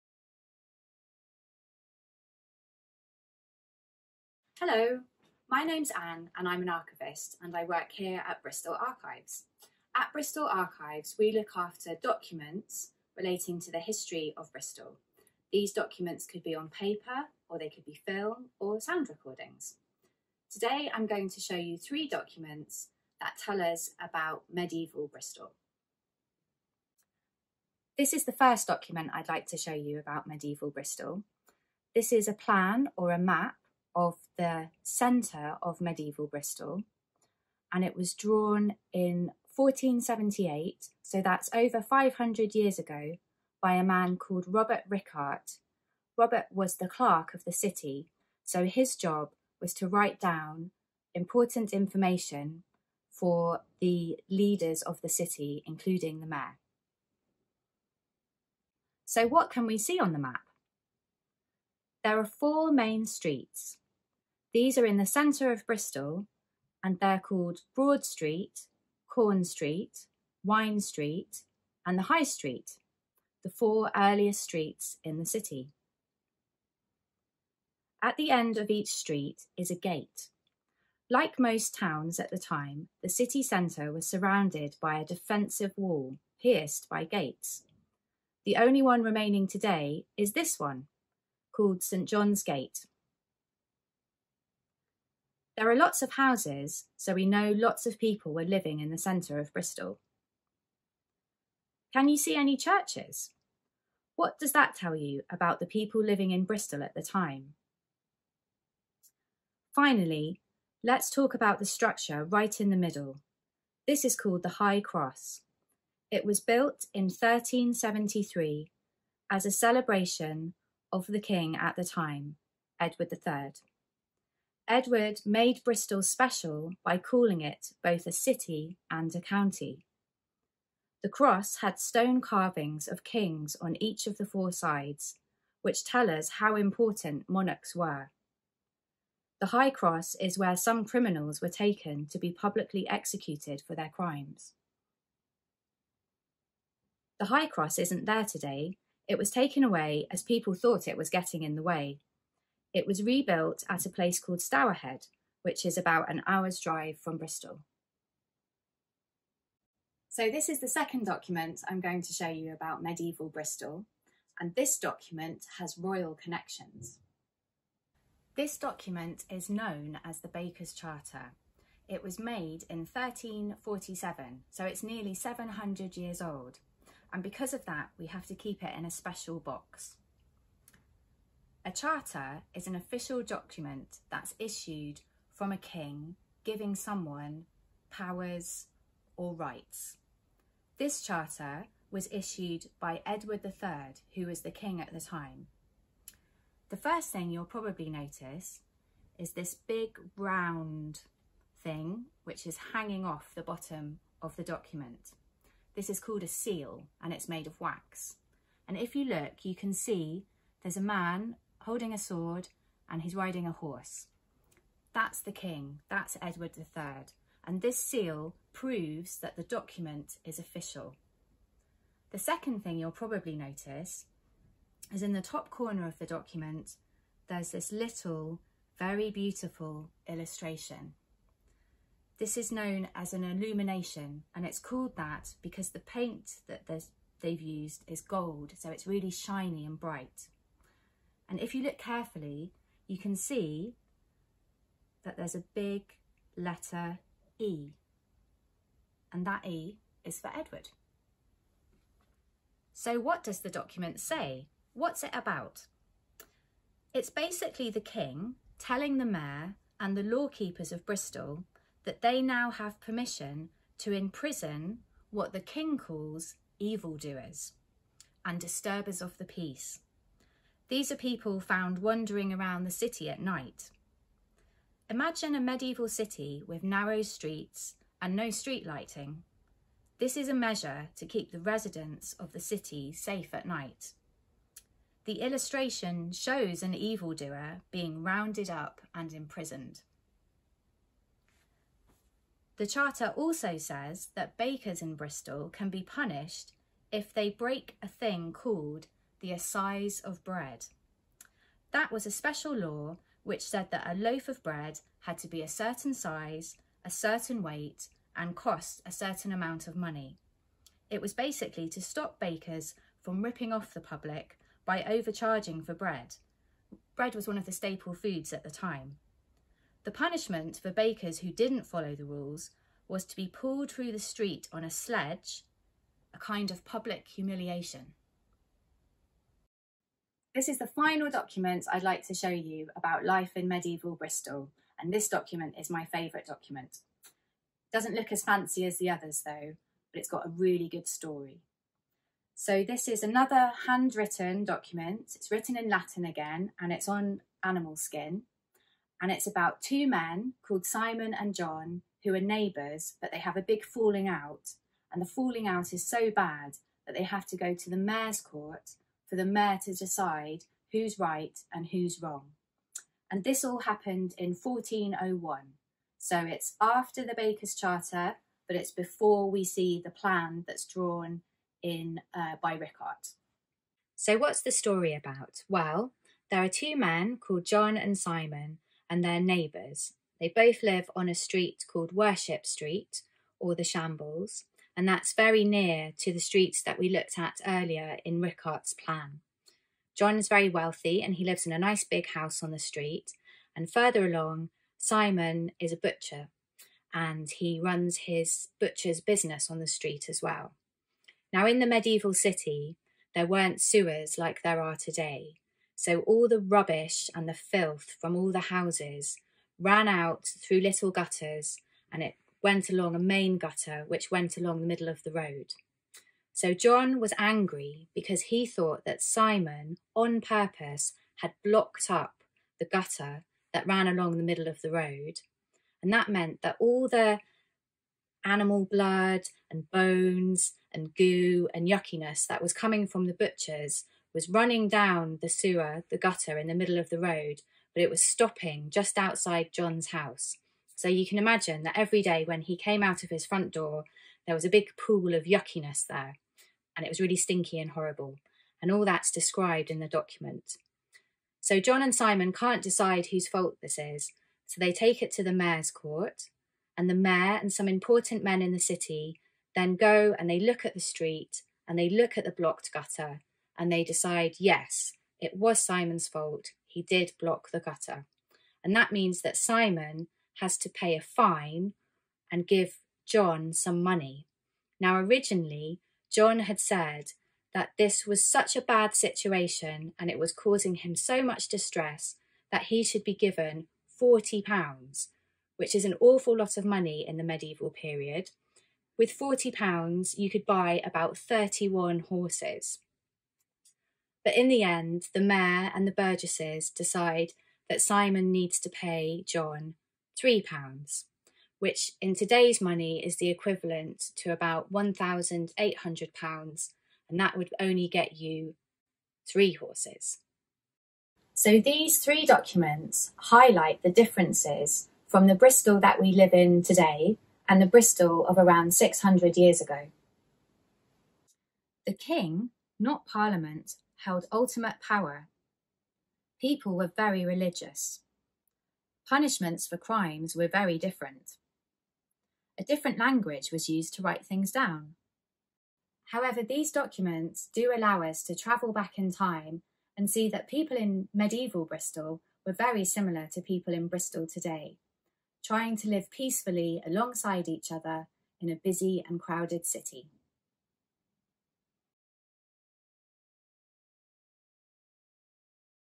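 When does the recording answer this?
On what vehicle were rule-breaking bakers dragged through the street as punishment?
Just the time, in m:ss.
5:24.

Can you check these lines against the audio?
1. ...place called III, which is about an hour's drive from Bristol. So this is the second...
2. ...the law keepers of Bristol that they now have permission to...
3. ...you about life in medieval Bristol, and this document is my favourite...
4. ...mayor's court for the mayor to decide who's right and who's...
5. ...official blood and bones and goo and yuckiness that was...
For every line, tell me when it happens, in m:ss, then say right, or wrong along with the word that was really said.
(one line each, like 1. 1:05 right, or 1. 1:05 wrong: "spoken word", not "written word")
1. 2:33 wrong: "Stourhead", not "III"
2. 4:19 right
3. 5:32 right
4. 5:57 right
5. 7:08 wrong: "animal", not "official".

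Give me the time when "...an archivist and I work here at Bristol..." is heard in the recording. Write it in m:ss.
0:06.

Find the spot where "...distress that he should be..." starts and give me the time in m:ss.
8:01.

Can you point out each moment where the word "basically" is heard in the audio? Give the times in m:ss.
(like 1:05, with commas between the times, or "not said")
4:17, 5:11.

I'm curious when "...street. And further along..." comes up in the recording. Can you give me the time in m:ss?
6:32.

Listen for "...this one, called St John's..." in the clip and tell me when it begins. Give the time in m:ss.
1:30.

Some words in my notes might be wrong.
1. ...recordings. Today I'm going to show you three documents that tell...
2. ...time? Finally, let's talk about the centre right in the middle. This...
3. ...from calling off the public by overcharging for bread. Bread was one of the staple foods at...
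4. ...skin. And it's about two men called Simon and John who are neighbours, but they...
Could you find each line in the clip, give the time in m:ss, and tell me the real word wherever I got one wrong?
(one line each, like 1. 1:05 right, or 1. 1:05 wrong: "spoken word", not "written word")
1. 0:19 right
2. 1:47 wrong: "structure", not "centre"
3. 5:13 wrong: "ripping", not "calling"
4. 5:47 right.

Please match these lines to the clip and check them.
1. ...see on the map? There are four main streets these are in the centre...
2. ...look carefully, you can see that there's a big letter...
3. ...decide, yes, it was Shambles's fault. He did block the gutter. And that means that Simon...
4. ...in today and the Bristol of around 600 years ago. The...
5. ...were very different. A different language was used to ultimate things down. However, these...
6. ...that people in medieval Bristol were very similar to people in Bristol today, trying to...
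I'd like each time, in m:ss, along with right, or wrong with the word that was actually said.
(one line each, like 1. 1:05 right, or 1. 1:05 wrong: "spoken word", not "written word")
1. 0:59 right
2. 4:01 right
3. 7:43 wrong: "Simon", not "Shambles"
4. 8:36 right
5. 8:50 wrong: "write", not "ultimate"
6. 9:00 right.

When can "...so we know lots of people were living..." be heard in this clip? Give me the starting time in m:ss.
1:36.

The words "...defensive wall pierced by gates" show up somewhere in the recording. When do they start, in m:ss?
1:25.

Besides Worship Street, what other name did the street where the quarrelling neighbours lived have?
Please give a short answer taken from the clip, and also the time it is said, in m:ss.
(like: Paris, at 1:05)
the Shambles, at 6:23.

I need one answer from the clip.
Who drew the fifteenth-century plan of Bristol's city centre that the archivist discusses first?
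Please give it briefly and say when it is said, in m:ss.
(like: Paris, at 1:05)
Robert Rickart, at 0:44.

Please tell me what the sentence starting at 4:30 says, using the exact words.
These are people found wandering around the city at night.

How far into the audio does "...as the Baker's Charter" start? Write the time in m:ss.
2:50.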